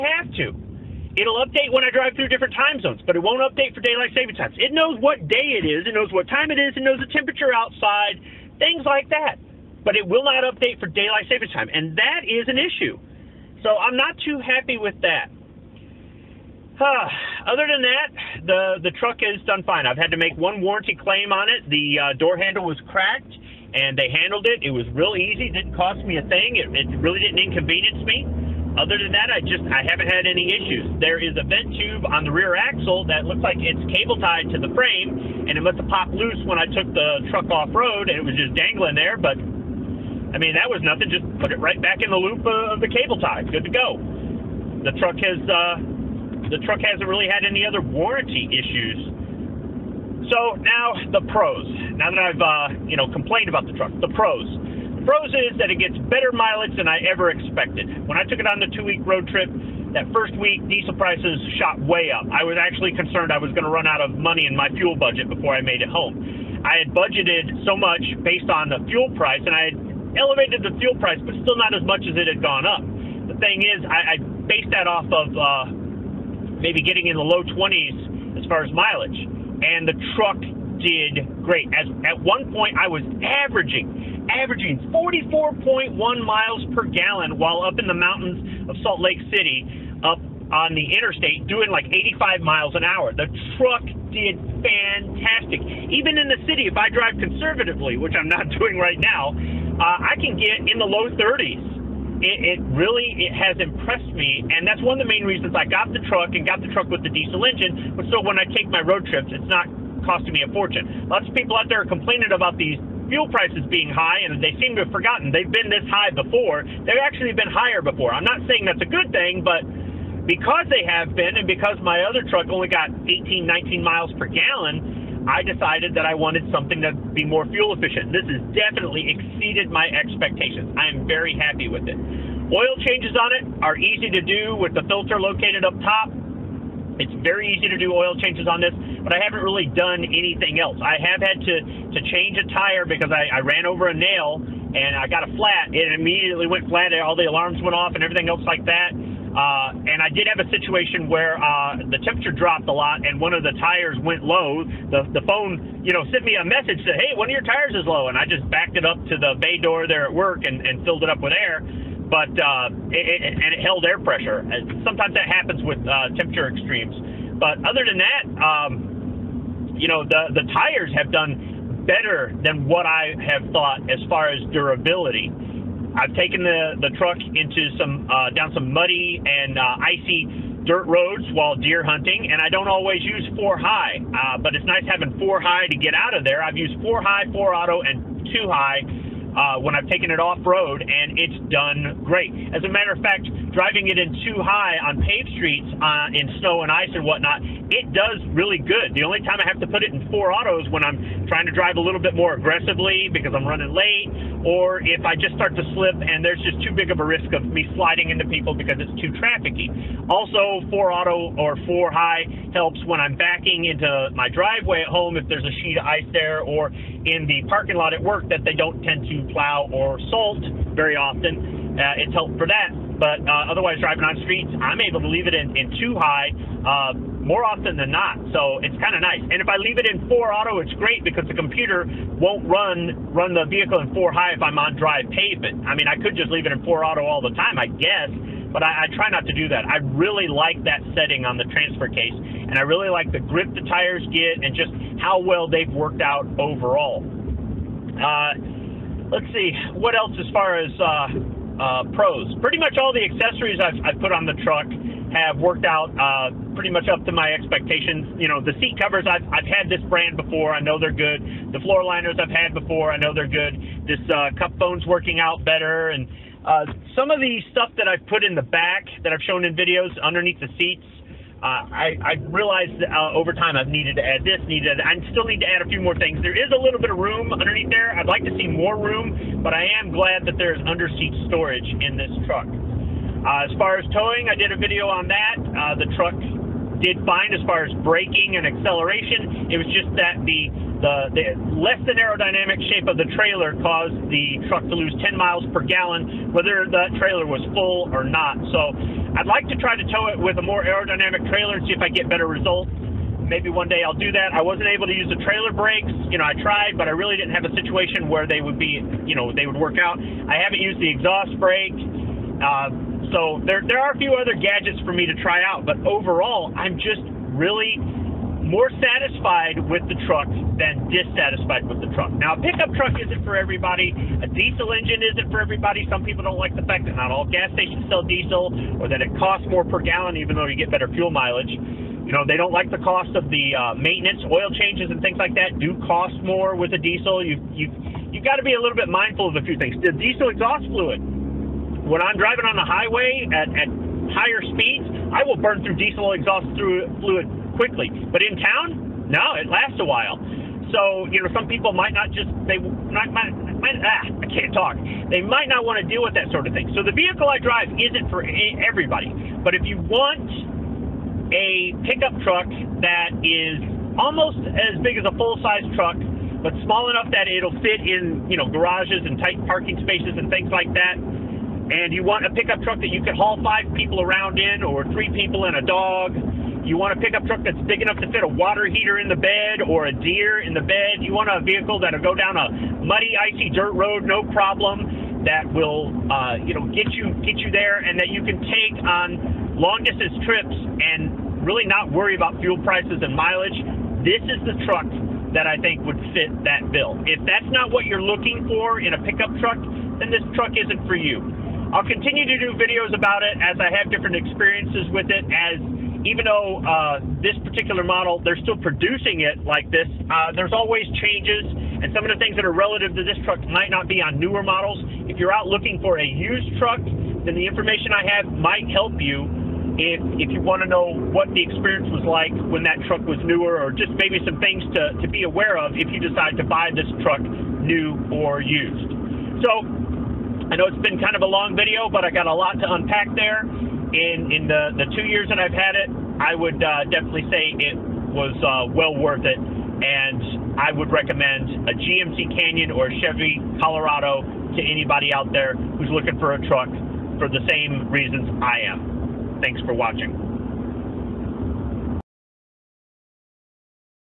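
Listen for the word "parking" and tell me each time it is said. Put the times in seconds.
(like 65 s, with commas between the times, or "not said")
217 s, 369 s.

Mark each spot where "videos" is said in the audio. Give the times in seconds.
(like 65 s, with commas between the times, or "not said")
269 s, 284 s, 402 s, 431 s.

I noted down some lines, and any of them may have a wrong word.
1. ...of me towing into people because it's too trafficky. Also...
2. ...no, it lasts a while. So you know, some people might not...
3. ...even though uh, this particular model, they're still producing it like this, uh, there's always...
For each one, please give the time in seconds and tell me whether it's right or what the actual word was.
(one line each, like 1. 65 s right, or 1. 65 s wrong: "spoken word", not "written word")
1. 207 s wrong: "sliding", not "towing"
2. 349 s right
3. 406 s right.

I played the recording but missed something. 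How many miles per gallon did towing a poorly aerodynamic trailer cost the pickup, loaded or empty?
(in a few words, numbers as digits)
10.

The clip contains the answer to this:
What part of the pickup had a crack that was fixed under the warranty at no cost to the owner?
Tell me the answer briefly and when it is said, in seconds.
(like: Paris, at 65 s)
Door handle, at 22 s.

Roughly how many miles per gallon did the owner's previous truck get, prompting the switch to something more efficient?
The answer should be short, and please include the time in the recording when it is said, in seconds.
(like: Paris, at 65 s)
18-19, at 123 s.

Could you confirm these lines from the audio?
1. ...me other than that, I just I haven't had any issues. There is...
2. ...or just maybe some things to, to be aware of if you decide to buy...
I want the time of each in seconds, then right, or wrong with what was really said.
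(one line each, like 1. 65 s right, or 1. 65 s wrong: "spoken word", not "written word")
1. 28 s right
2. 423 s right.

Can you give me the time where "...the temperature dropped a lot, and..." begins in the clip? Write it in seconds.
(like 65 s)
151 s.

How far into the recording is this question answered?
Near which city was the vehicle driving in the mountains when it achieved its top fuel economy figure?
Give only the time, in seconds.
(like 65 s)
88 s.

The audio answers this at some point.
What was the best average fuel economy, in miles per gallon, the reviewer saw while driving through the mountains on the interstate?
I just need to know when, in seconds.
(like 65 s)
84 s.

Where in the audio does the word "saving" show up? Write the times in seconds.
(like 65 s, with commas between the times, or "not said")
4 s, 11 s.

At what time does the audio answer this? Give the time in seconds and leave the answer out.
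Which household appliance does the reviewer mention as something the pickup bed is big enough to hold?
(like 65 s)
378 s.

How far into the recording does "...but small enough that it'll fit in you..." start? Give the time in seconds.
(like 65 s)
366 s.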